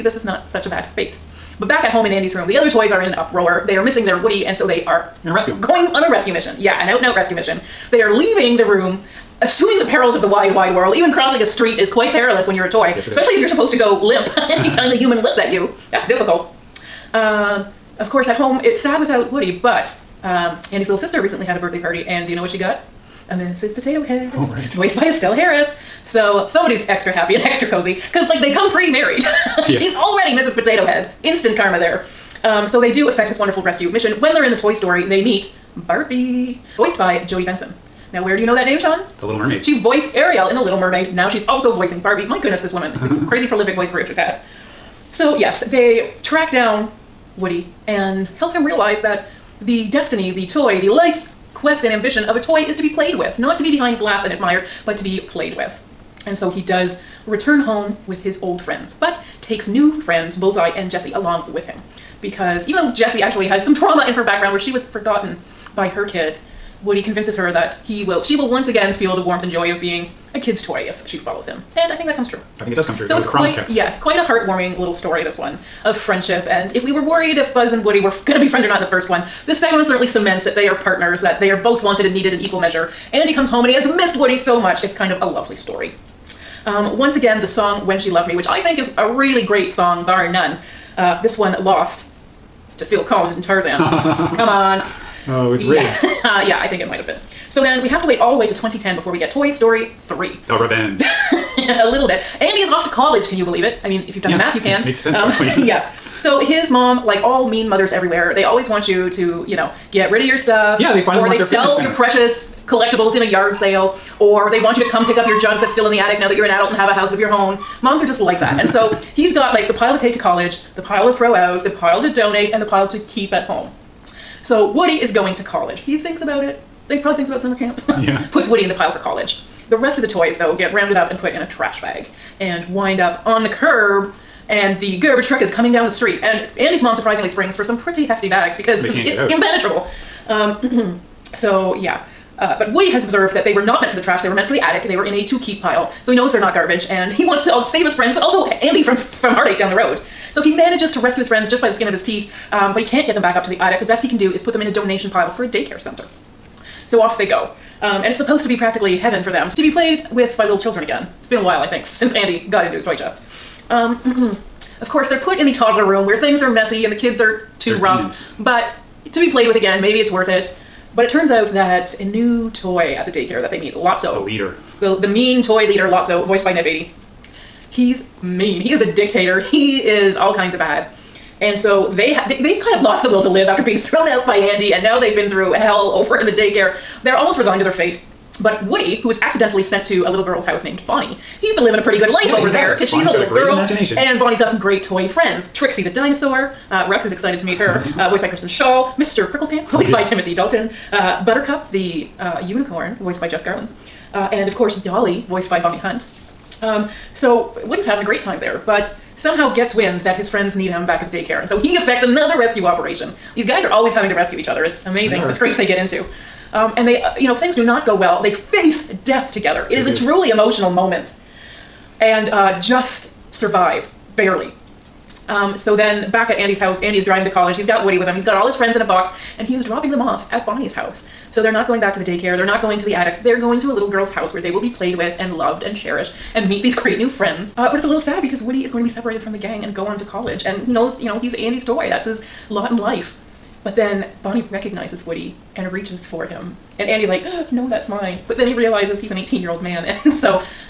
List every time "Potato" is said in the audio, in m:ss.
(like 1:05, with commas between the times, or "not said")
0:23, 0:30.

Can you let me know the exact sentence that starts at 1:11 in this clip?
And I think that comes true.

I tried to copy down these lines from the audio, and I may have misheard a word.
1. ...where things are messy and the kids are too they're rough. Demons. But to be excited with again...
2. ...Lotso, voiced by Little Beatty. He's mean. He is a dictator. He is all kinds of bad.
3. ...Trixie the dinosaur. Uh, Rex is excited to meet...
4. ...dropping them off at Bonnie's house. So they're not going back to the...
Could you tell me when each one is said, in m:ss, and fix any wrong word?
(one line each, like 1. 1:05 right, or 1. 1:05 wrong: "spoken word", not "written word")
1. 2:46 wrong: "played", not "excited"
2. 2:55 wrong: "Ned", not "Little"
3. 3:15 right
4. 3:49 right.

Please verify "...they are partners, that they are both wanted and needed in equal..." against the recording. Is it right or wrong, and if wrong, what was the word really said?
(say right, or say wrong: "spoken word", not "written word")
right.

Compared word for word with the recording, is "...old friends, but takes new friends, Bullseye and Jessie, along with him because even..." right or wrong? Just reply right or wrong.
right.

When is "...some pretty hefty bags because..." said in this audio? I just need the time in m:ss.
2:17.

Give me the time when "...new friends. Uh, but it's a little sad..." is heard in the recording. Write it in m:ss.
3:56.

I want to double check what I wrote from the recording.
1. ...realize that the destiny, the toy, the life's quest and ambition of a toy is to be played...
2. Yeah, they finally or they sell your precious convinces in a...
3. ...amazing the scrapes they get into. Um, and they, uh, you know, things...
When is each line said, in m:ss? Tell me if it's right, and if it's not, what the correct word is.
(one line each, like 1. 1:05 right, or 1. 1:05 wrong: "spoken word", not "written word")
1. 0:48 right
2. 1:50 wrong: "collectibles", not "convinces"
3. 3:34 right.